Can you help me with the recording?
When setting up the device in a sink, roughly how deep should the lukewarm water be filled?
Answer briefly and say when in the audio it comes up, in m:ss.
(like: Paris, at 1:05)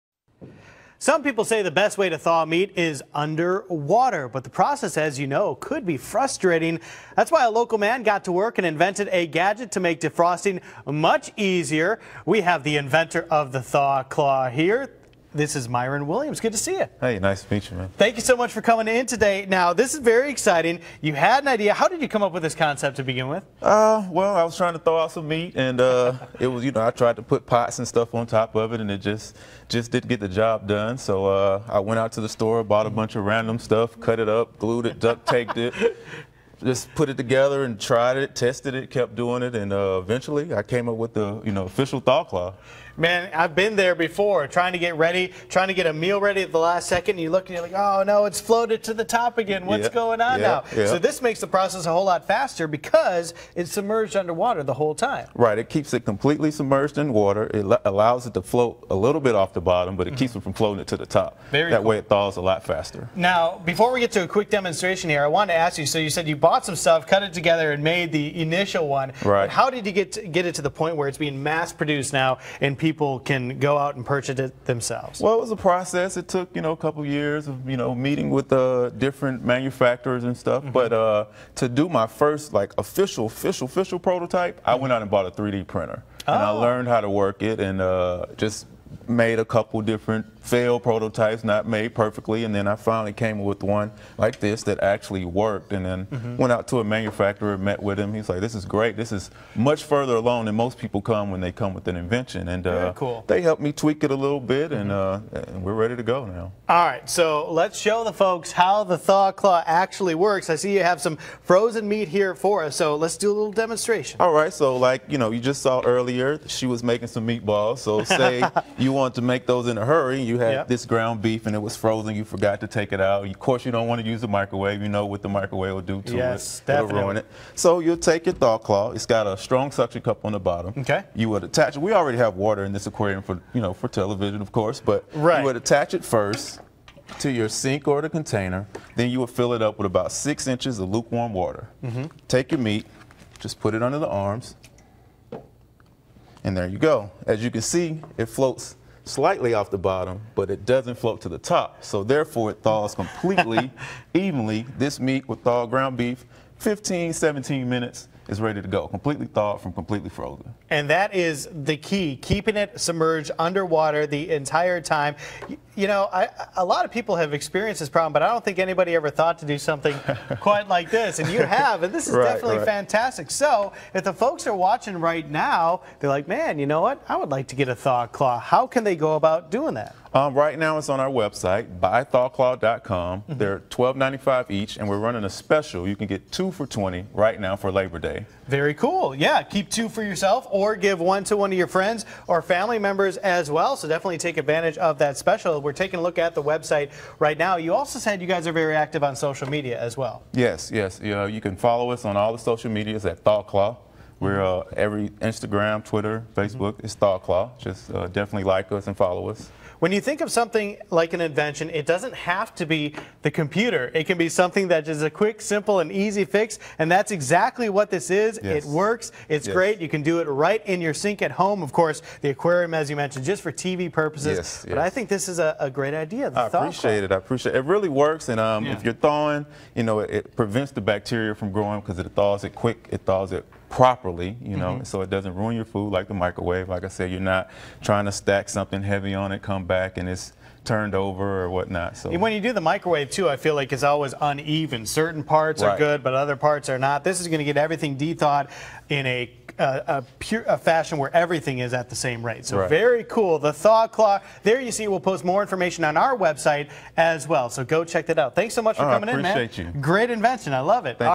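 6 inches, at 2:20.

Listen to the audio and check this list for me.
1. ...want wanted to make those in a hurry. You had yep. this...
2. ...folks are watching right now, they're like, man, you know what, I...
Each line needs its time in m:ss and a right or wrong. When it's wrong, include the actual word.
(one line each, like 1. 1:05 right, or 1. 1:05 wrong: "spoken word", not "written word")
1. 1:58 right
2. 2:54 right.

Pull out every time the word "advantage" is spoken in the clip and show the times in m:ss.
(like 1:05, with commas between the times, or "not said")
3:14.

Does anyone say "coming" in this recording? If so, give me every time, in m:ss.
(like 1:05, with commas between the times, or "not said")
0:18, 4:18.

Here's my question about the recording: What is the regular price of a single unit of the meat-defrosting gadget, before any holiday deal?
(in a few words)
$12.95.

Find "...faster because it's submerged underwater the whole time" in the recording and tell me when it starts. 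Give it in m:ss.
0:52.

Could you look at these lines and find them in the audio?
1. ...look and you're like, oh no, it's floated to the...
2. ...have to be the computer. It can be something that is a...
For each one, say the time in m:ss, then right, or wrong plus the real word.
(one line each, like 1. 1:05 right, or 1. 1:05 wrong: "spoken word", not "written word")
1. 0:47 right
2. 3:32 right.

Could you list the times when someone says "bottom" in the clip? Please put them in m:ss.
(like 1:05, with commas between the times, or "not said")
0:59, 2:10, 2:29.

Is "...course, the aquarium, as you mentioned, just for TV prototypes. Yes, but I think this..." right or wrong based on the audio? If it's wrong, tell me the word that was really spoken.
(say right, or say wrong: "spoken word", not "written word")
wrong: "purposes", not "prototypes".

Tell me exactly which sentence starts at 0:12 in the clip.
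We have the inventor of the thaw claw here.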